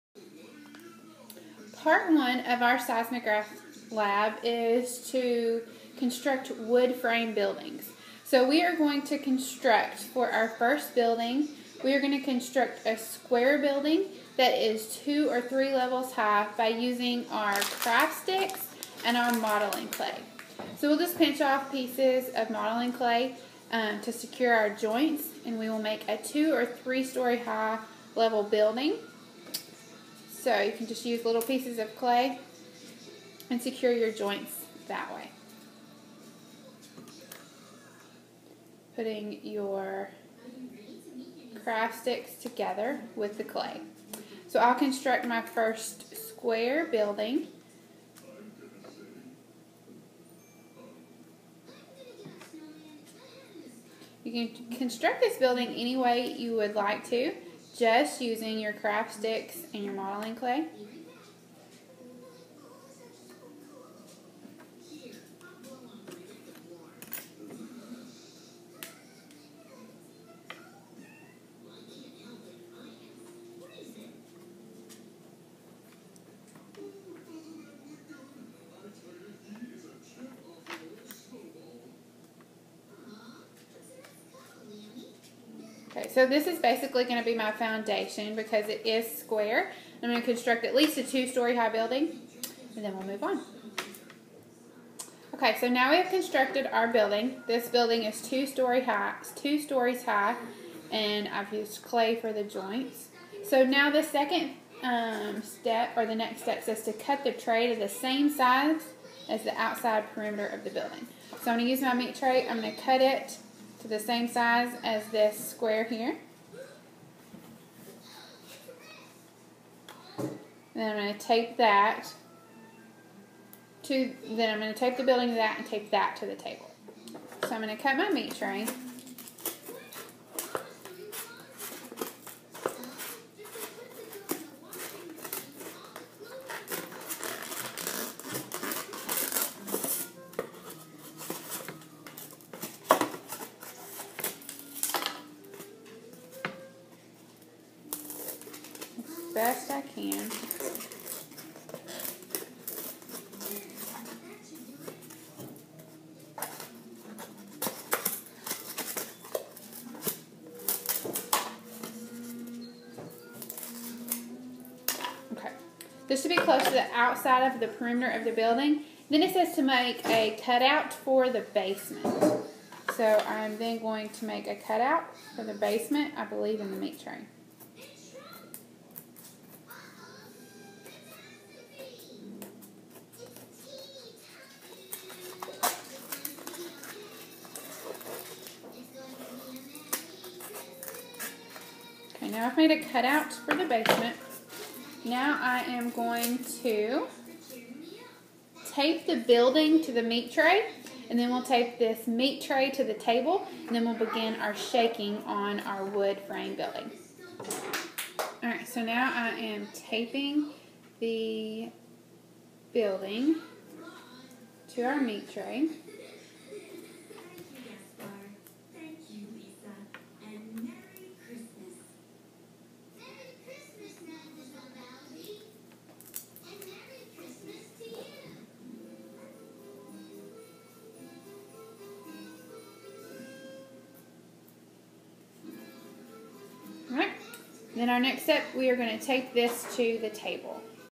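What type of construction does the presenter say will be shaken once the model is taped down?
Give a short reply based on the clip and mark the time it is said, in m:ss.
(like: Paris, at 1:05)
wood frame building, at 3:25.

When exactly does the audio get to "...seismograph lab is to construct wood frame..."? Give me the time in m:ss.
0:02.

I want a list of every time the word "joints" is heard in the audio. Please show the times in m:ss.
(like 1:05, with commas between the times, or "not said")
0:24, 0:34, 1:42.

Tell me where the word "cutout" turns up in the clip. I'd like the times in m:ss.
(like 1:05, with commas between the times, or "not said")
2:50, 2:54, 3:12.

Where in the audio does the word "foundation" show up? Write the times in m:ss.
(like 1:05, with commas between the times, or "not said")
1:27.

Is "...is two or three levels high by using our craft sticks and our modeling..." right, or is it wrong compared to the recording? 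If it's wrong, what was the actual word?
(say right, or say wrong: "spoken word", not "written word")
right.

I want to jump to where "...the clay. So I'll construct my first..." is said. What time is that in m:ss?
0:43.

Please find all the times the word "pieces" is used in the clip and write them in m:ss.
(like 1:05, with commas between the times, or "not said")
0:21, 0:31.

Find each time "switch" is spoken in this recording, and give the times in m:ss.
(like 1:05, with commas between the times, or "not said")
not said.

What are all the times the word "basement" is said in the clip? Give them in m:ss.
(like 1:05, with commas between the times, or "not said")
2:51, 2:55, 3:13.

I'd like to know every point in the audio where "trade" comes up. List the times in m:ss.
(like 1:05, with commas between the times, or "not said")
not said.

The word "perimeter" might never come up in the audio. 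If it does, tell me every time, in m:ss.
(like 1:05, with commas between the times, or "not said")
1:50, 2:47.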